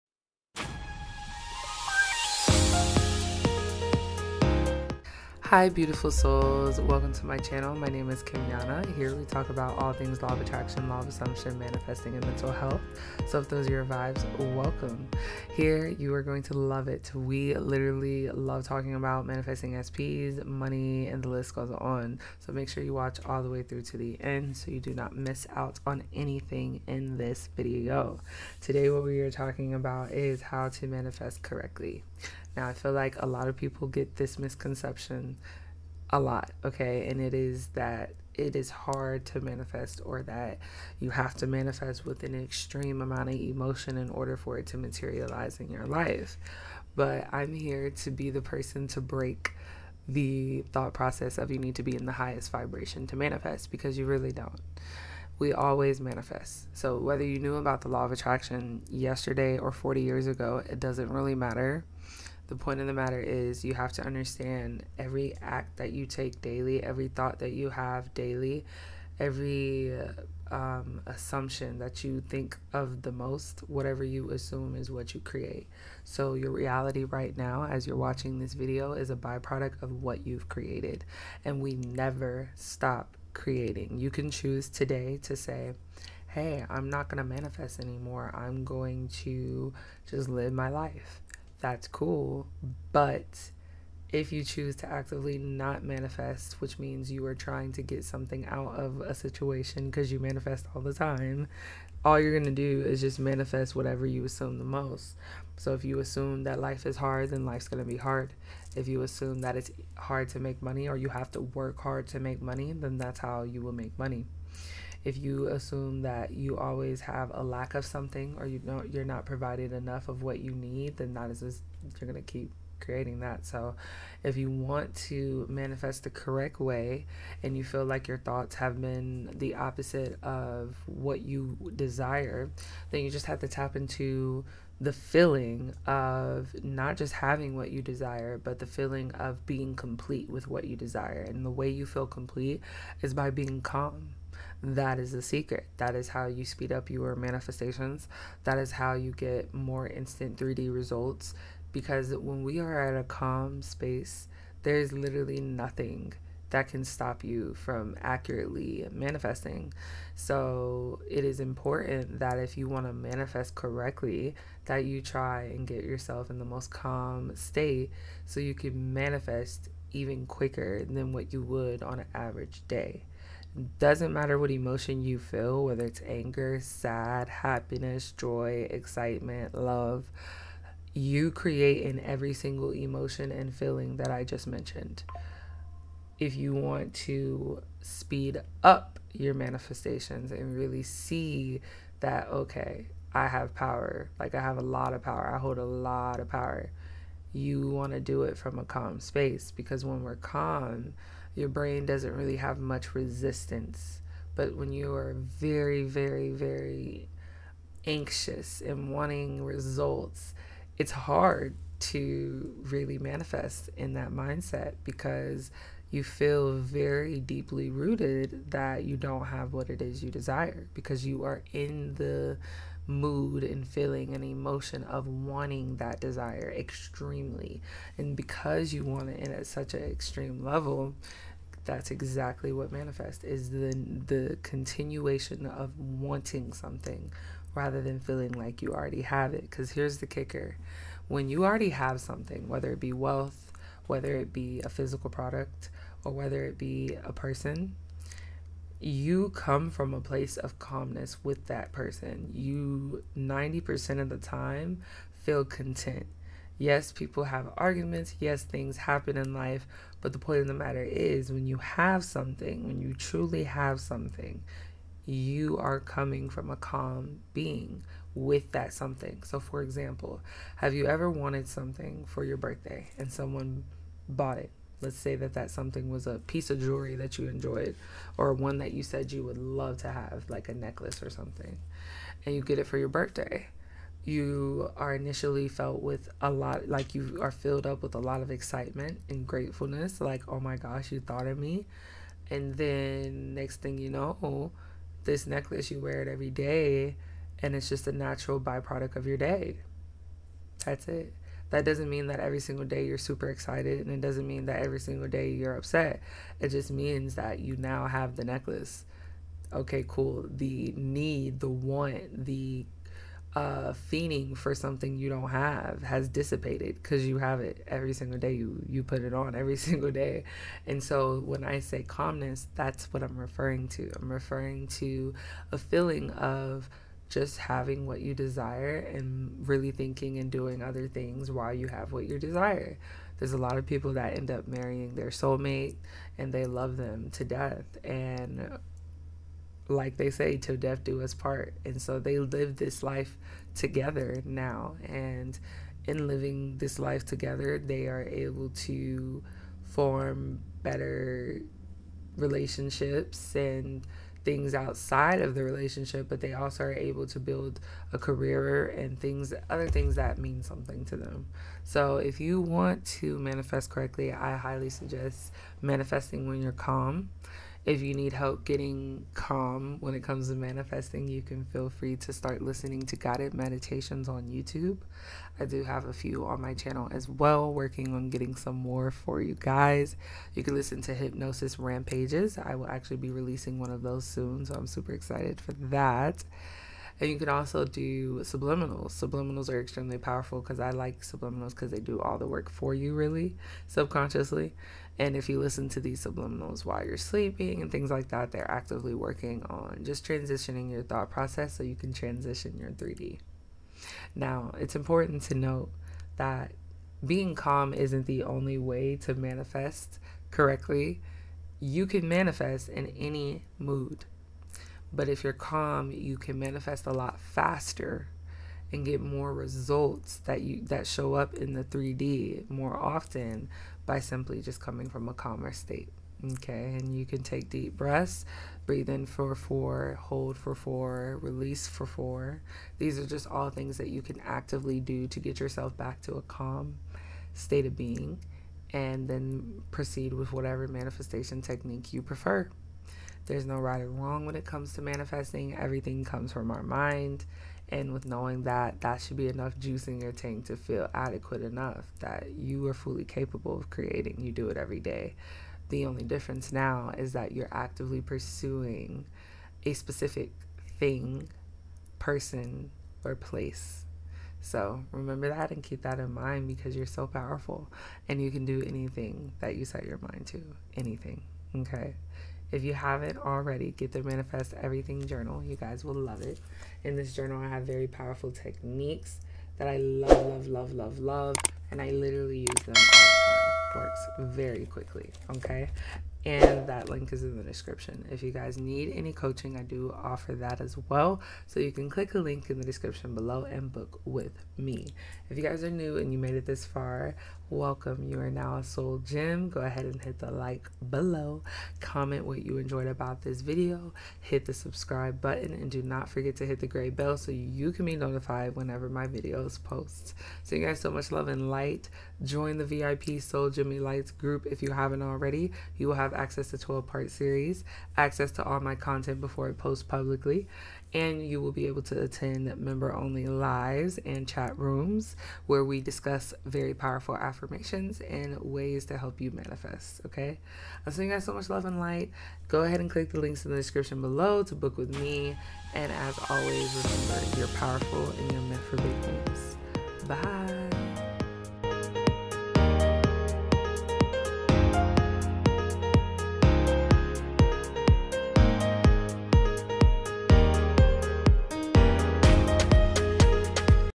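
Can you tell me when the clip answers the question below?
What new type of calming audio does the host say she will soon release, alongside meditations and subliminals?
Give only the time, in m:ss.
6:20.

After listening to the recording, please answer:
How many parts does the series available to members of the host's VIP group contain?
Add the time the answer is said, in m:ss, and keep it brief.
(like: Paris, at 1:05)
12, at 8:36.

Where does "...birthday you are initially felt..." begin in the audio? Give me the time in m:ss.
4:42.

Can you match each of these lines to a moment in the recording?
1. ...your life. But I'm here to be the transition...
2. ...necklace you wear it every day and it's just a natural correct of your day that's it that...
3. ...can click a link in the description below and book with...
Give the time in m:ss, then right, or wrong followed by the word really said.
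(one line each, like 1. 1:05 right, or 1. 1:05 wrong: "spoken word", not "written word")
1. 0:45 wrong: "person", not "transition"
2. 4:55 wrong: "byproduct", not "correct"
3. 8:11 right.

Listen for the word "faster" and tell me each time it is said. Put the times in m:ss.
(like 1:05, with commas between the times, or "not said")
6:57.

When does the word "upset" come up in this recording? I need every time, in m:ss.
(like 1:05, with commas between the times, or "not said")
5:05.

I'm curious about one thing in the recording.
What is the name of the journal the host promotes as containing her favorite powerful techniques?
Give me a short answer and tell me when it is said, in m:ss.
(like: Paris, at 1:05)
Manifest Everything Journal, at 7:54.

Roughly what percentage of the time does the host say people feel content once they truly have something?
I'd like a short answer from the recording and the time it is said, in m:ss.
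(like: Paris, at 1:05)
90%, at 4:13.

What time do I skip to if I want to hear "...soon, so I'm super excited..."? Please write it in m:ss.
6:24.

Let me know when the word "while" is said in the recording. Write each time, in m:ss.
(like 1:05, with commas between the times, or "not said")
5:31, 6:36.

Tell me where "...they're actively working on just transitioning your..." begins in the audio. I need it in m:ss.
6:38.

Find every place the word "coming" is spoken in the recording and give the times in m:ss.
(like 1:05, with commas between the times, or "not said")
4:25, 7:04.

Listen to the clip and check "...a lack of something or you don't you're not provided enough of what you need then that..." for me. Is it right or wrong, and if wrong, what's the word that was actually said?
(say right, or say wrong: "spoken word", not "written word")
right.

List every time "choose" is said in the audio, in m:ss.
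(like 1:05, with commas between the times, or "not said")
1:24, 1:34.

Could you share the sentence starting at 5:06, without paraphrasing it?
It just means that you now have the necklace.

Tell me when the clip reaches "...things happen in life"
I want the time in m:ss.
4:18.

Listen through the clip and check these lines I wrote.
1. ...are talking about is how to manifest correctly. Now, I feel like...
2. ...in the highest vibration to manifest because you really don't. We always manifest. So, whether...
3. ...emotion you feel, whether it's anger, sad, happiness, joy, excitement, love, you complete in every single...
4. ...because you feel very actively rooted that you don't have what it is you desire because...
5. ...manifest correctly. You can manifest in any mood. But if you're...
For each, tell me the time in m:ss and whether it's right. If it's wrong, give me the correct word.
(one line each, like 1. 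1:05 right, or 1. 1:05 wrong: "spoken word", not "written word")
1. 0:29 right
2. 0:51 right
3. 2:54 wrong: "create", not "complete"
4. 3:34 wrong: "deeply", not "actively"
5. 6:49 right.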